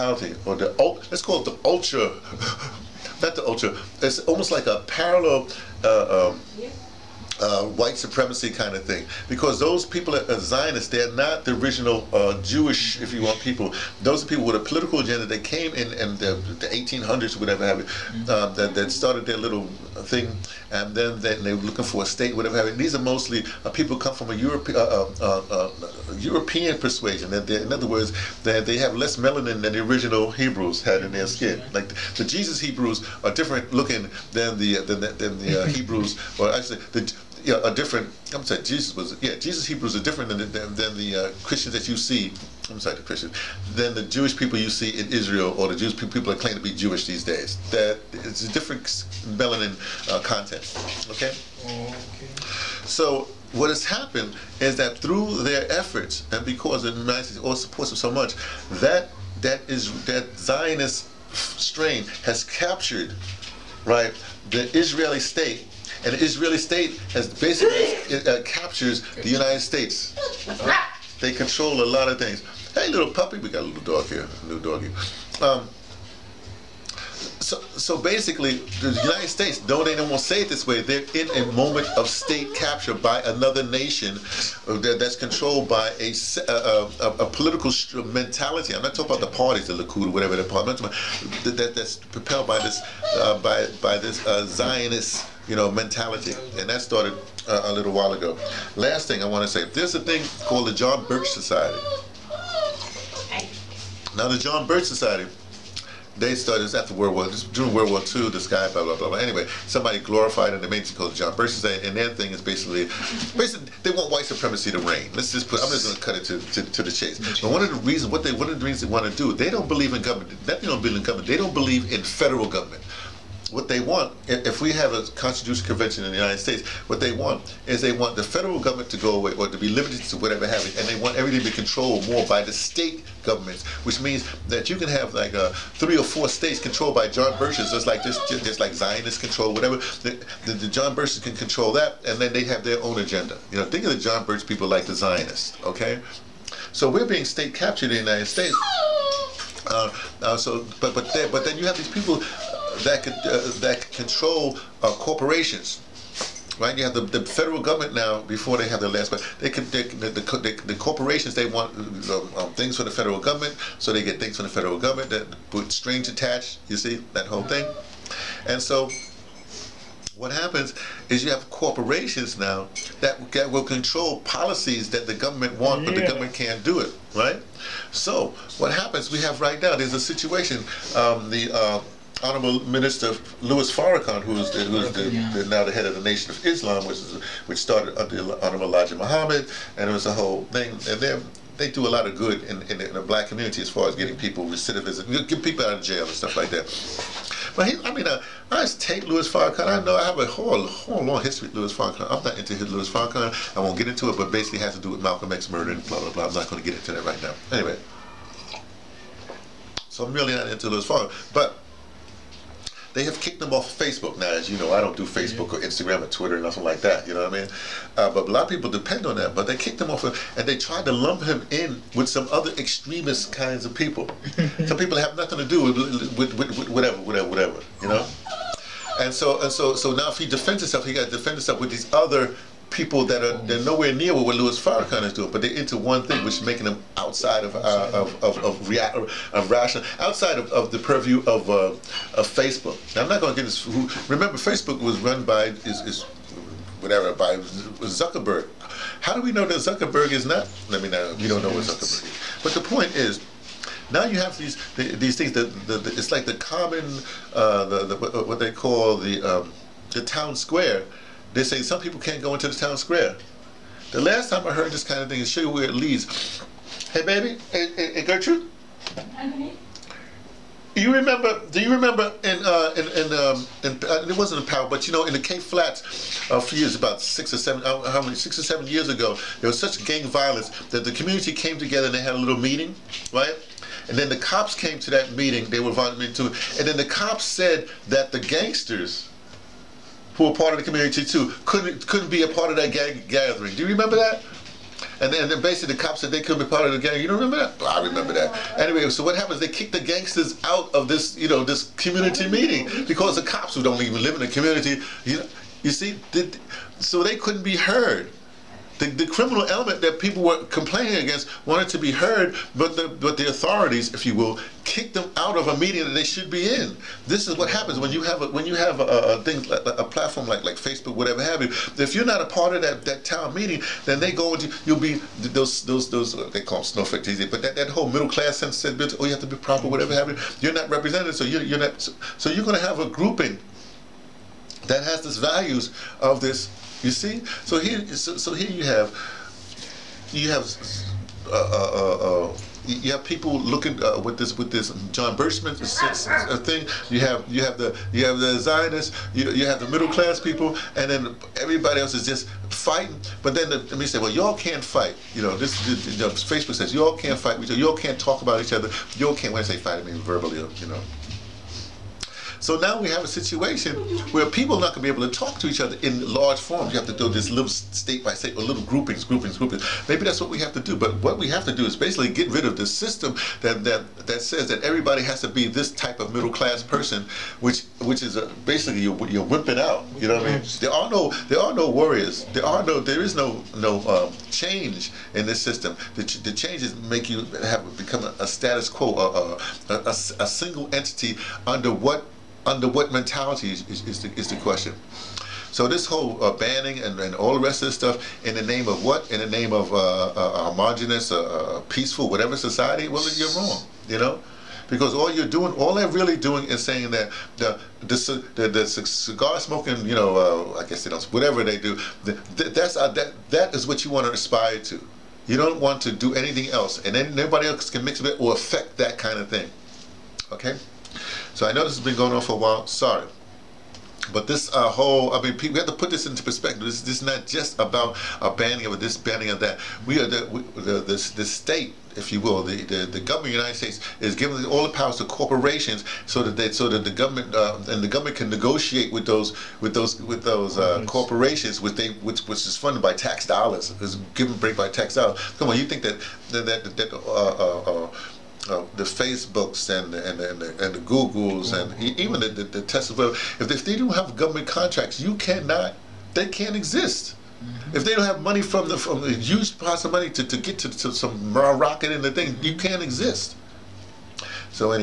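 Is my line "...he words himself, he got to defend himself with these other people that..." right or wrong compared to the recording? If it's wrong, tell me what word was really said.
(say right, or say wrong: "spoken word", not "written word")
wrong: "defends", not "words".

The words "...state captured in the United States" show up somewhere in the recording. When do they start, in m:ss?
2:27.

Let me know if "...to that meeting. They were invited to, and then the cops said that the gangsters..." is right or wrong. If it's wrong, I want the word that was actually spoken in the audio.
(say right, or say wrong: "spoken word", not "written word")
right.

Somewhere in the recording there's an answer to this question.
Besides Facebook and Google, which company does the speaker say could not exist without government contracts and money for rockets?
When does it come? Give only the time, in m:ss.
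7:32.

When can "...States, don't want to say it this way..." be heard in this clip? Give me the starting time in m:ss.
1:19.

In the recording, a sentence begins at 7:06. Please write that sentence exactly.
This, this is not just about a banning of this, banning of that.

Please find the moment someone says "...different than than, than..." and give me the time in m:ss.
0:40.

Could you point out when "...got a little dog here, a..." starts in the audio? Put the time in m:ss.
1:13.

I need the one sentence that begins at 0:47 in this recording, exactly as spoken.
That it's a different melanin uh, content.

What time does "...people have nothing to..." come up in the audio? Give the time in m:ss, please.
3:44.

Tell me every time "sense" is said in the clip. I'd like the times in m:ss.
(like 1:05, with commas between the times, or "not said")
5:28.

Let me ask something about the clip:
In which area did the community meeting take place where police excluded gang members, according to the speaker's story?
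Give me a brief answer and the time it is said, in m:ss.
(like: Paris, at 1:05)
Cape Flats, at 4:35.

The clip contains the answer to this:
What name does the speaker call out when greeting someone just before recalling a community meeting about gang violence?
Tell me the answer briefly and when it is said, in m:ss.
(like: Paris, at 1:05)
Gertrude, at 4:28.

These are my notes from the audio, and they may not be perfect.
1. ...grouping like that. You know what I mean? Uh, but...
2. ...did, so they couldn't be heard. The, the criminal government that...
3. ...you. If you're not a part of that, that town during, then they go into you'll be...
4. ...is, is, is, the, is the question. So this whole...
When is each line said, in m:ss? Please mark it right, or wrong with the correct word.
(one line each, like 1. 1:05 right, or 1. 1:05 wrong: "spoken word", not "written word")
1. 3:36 wrong: "nothing", not "grouping"
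2. 5:06 wrong: "element", not "government"
3. 5:21 wrong: "meeting", not "during"
4. 6:33 right.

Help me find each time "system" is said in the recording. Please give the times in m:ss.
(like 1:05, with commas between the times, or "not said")
6:12, 6:25.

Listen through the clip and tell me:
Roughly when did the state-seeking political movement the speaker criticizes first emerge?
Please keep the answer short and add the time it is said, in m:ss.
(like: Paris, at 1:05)
1800s, at 0:16.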